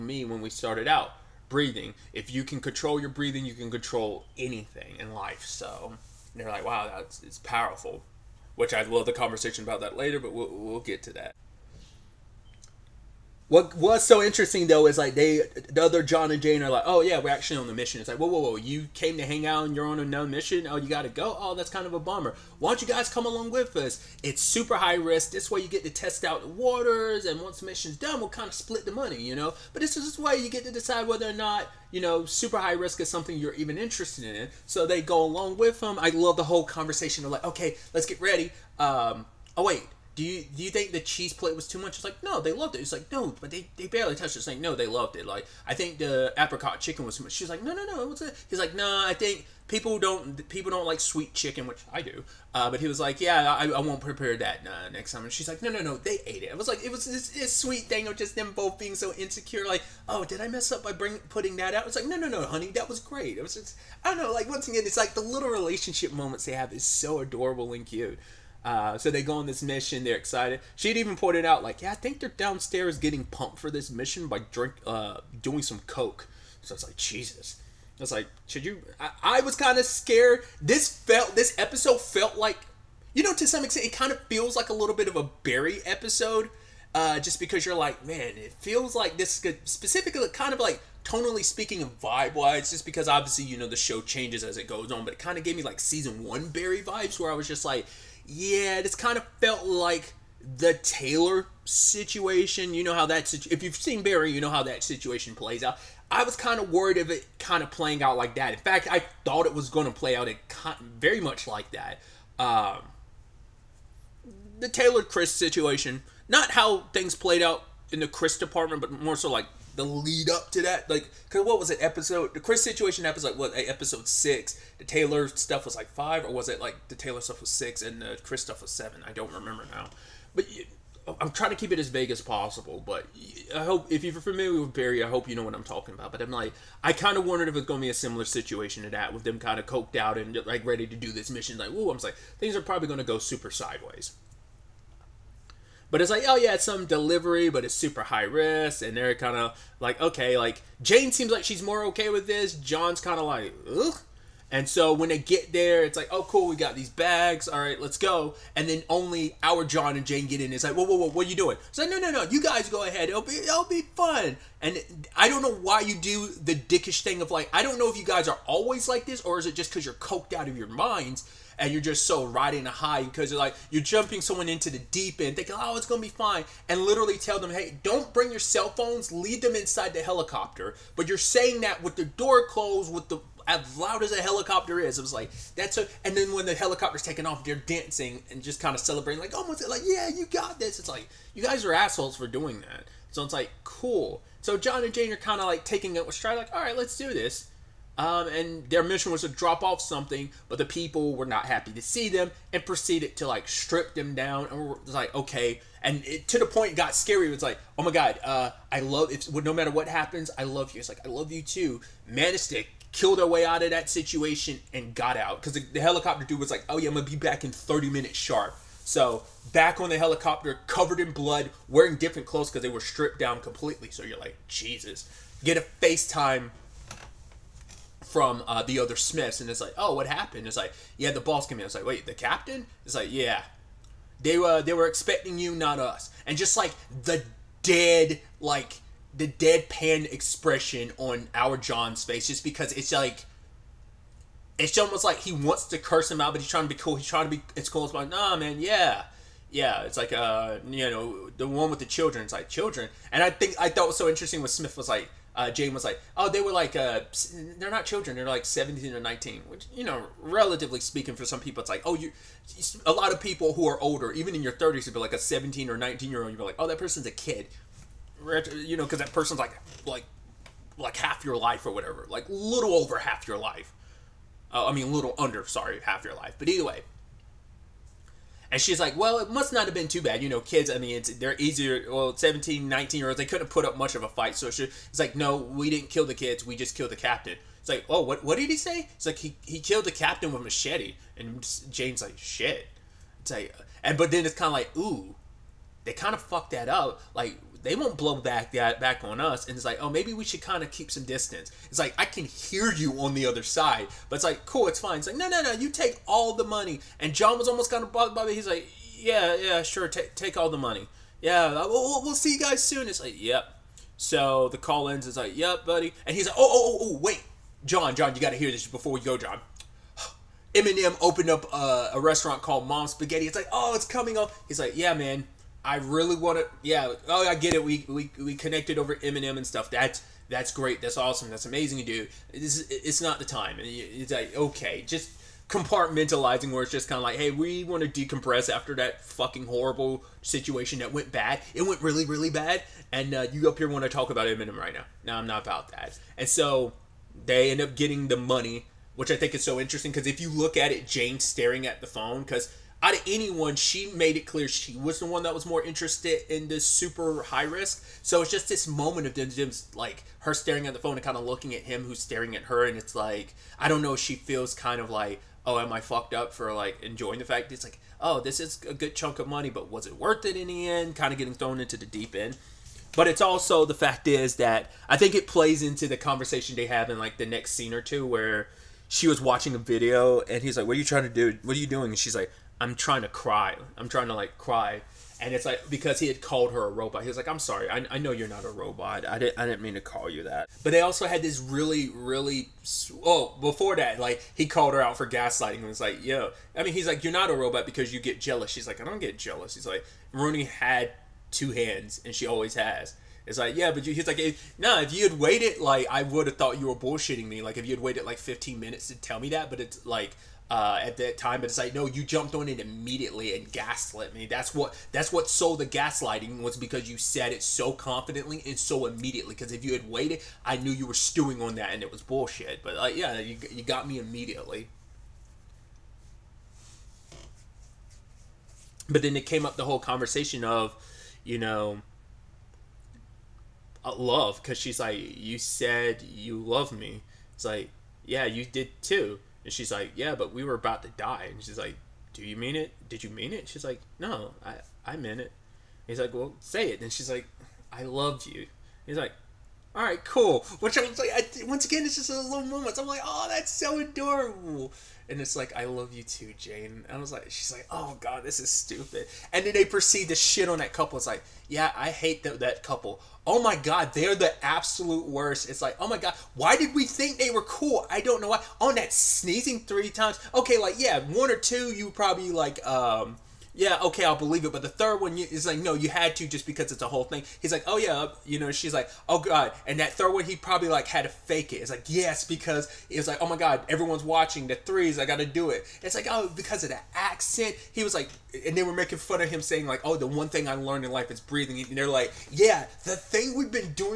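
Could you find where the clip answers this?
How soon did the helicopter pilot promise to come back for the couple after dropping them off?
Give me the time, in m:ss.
3:37.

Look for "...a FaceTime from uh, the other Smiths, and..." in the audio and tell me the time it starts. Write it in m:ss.
3:45.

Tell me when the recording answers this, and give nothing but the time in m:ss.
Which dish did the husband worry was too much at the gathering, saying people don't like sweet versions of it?
0:46.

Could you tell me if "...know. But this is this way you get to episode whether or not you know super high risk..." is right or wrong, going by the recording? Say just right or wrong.
wrong.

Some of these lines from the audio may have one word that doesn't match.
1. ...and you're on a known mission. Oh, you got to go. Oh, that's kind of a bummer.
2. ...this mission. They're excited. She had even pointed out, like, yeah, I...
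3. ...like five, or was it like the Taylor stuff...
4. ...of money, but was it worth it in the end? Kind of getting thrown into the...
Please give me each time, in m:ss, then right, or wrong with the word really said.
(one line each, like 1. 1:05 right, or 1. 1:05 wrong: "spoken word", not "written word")
1. 0:19 right
2. 1:09 right
3. 2:05 right
4. 6:09 right.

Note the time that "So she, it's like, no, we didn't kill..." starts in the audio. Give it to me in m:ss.
4:44.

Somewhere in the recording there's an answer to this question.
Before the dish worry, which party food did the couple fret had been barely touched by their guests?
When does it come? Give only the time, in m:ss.
0:40.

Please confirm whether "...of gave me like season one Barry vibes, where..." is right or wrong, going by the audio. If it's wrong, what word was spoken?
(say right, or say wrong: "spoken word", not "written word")
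right.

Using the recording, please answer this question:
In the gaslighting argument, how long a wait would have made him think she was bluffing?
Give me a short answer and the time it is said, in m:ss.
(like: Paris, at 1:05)
15 minutes, at 6:48.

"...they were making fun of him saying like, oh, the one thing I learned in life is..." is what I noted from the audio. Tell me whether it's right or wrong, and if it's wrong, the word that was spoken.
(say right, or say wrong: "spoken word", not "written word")
right.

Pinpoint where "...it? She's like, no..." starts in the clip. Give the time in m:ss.
7:23.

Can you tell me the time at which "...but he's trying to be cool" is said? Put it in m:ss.
4:06.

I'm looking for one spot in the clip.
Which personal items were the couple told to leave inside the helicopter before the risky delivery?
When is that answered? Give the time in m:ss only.
2:58.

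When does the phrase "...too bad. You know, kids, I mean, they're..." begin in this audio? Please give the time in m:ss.
4:39.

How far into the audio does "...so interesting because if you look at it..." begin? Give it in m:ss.
5:49.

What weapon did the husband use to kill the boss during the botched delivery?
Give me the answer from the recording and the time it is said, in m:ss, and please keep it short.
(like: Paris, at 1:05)
Machete, at 4:50.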